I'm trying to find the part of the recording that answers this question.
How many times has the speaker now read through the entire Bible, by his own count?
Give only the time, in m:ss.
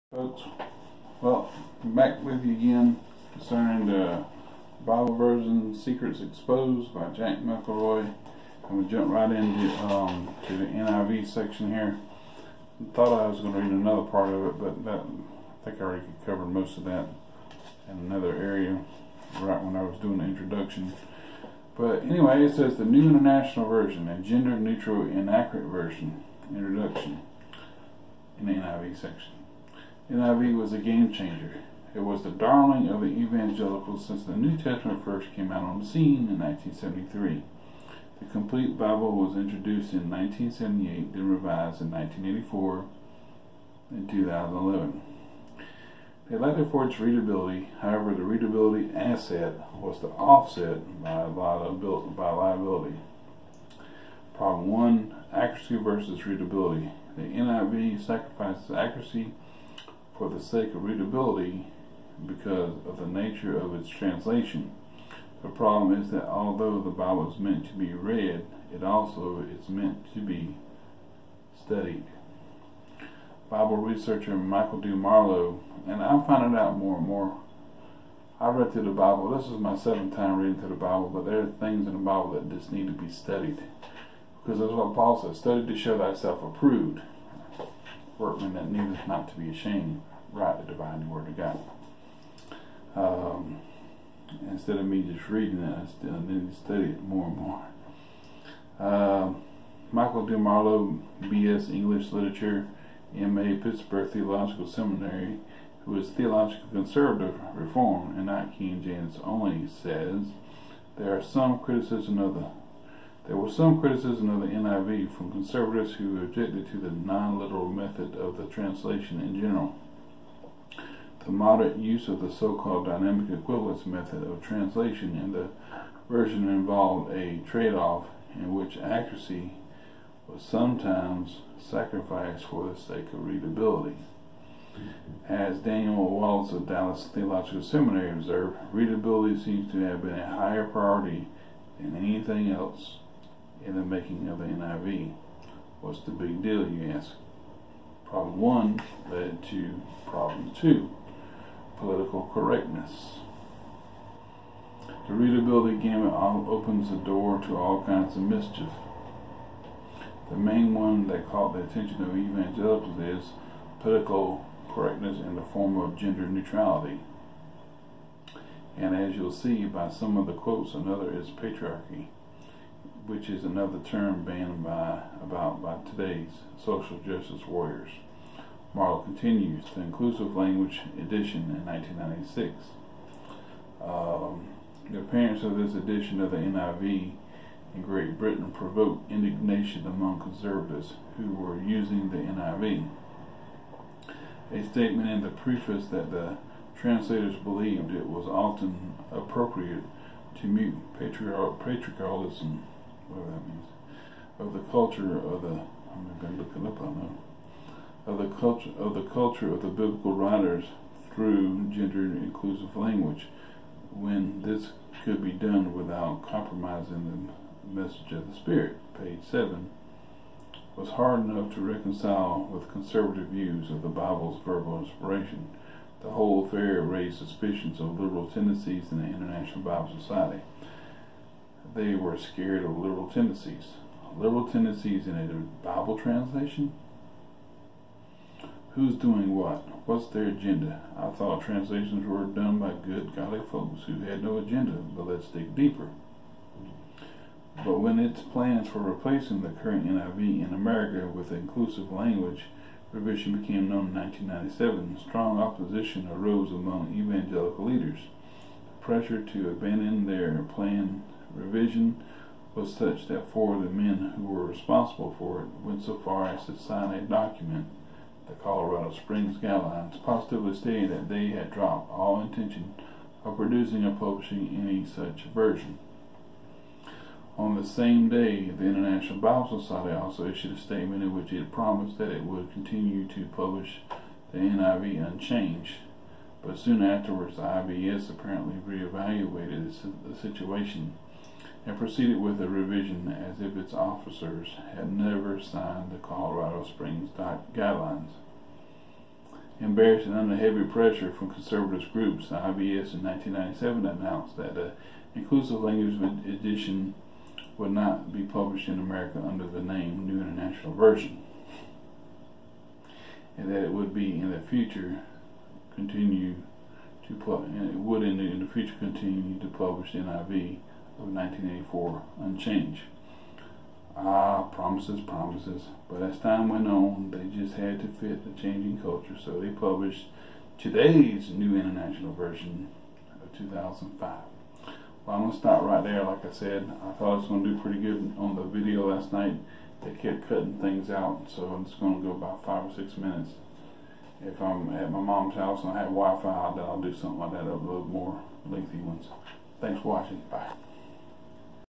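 1:19.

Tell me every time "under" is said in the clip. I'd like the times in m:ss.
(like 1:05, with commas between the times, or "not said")
5:00, 5:09.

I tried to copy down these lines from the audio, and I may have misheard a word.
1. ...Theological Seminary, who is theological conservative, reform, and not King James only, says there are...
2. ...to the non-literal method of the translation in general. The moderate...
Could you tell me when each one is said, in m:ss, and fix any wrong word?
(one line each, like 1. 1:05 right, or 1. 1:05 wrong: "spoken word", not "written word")
1. 1:44 right
2. 1:56 right.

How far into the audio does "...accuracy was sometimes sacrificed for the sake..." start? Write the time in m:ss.
2:08.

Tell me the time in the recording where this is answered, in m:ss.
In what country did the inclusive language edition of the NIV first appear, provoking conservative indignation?
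3:07.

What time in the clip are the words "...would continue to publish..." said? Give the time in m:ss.
4:42.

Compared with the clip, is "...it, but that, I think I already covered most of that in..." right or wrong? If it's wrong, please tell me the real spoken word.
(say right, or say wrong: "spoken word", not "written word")
right.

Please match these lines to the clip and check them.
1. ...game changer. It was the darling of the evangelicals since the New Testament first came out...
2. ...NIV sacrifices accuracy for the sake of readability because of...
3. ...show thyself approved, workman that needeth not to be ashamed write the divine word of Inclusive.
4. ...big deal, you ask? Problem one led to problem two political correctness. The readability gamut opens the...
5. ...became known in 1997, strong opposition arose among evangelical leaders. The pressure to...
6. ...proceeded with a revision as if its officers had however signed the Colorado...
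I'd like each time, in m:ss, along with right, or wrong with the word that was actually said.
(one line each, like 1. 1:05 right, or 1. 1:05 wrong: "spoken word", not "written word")
1. 0:30 right
2. 0:57 right
3. 1:25 wrong: "God", not "Inclusive"
4. 2:26 right
5. 4:13 right
6. 4:51 wrong: "never", not "however".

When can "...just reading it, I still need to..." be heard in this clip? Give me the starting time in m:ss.
1:35.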